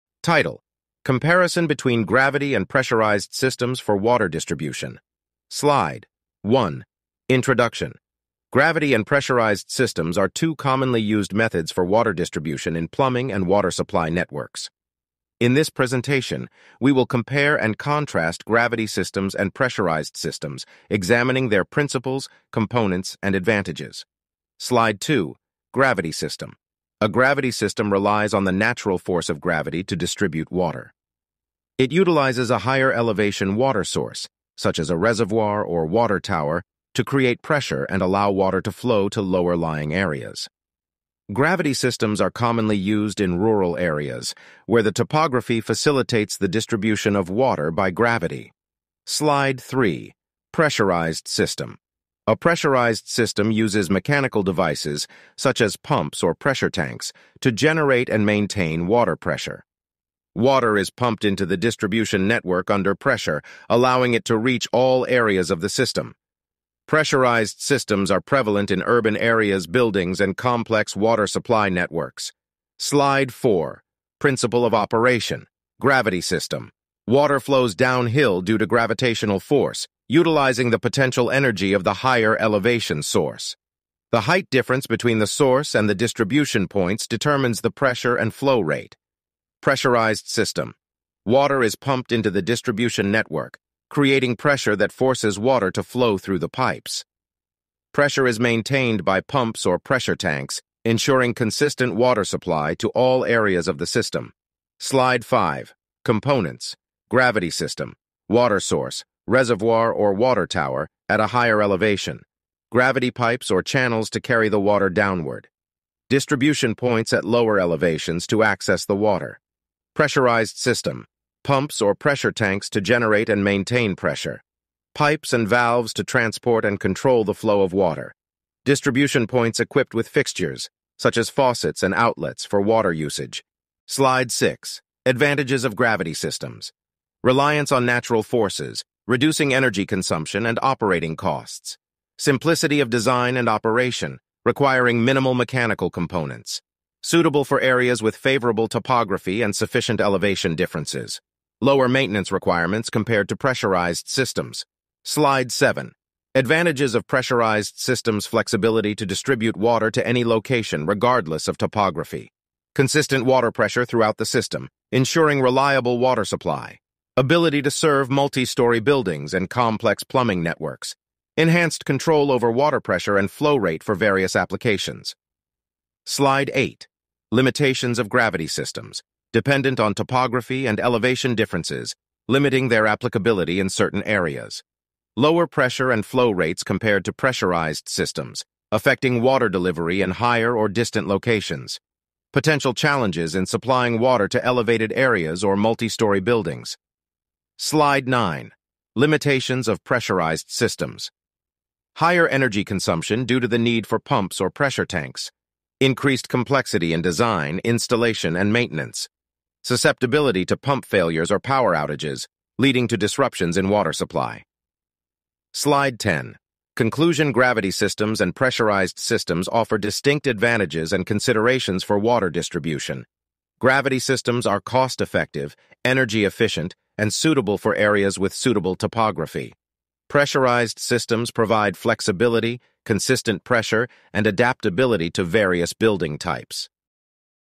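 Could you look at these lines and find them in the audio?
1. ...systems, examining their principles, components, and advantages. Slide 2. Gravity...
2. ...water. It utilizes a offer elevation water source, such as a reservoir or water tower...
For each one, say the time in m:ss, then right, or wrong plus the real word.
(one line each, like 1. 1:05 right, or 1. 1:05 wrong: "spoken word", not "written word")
1. 0:20 right
2. 0:30 wrong: "higher", not "offer".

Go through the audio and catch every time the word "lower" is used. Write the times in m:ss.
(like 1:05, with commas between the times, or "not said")
0:39, 1:57, 2:31, 3:05.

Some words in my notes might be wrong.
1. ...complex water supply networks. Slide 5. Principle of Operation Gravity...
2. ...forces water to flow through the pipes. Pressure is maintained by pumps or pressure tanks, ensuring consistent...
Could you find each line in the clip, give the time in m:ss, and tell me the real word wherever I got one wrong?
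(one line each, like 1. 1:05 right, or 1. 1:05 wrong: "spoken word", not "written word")
1. 1:10 wrong: "4", not "5"
2. 1:34 right.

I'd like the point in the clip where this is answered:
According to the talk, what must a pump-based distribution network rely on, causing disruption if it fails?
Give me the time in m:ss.
3:31.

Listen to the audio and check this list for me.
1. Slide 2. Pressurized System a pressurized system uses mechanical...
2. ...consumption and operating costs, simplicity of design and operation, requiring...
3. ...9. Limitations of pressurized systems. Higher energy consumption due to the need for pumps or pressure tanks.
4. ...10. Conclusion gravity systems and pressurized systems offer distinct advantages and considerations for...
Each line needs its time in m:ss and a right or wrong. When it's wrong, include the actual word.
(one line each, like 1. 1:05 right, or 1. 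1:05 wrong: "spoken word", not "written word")
1. 0:49 wrong: "3", not "2"
2. 2:19 right
3. 3:18 right
4. 3:35 right.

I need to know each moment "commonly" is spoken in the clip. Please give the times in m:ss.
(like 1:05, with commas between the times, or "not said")
0:10, 0:42.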